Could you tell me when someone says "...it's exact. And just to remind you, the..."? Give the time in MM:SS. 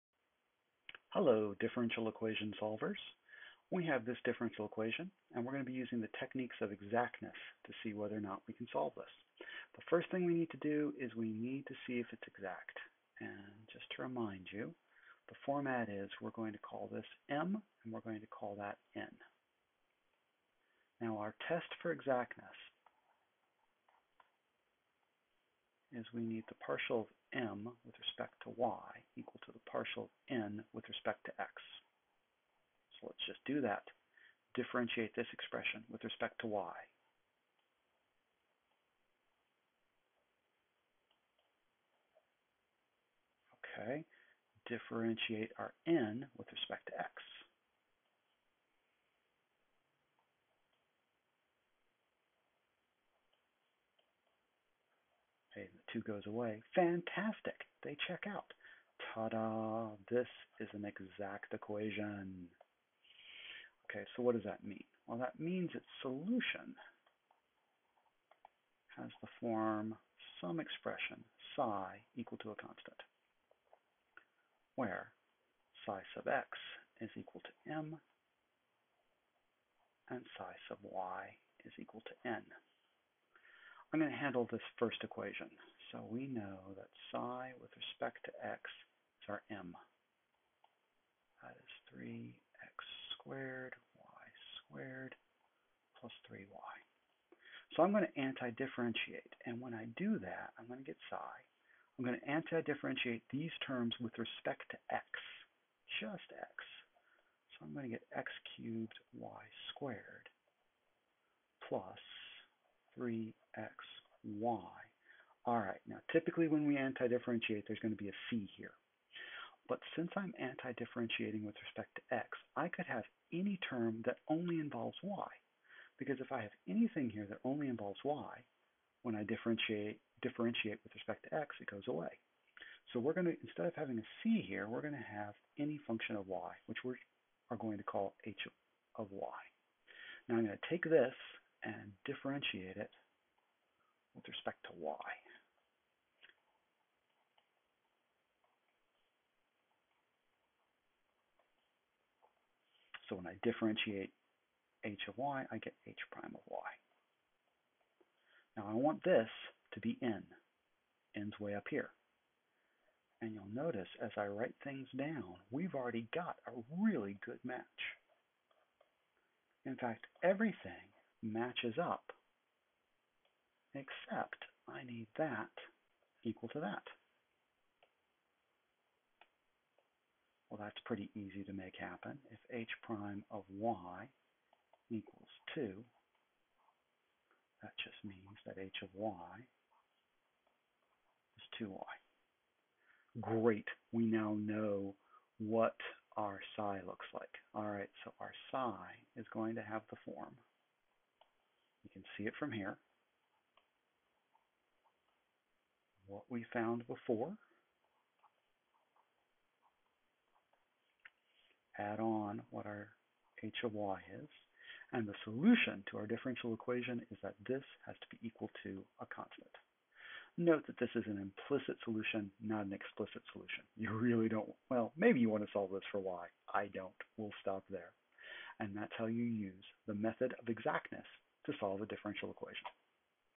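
00:12.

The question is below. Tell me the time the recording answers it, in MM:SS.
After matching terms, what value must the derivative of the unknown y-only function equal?
03:05.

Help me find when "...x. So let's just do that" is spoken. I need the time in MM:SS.
00:31.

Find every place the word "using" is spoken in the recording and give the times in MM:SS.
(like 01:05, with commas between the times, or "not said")
00:05.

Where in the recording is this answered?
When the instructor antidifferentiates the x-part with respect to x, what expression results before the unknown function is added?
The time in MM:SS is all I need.
01:48.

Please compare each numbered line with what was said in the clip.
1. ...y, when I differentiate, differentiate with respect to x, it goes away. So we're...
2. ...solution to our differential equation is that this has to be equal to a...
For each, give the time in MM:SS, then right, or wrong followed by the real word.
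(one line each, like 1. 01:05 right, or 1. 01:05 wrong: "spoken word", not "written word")
1. 02:08 right
2. 03:35 right.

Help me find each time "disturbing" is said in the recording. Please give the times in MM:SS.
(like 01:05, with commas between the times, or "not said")
not said.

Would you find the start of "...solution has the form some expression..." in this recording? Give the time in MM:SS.
01:06.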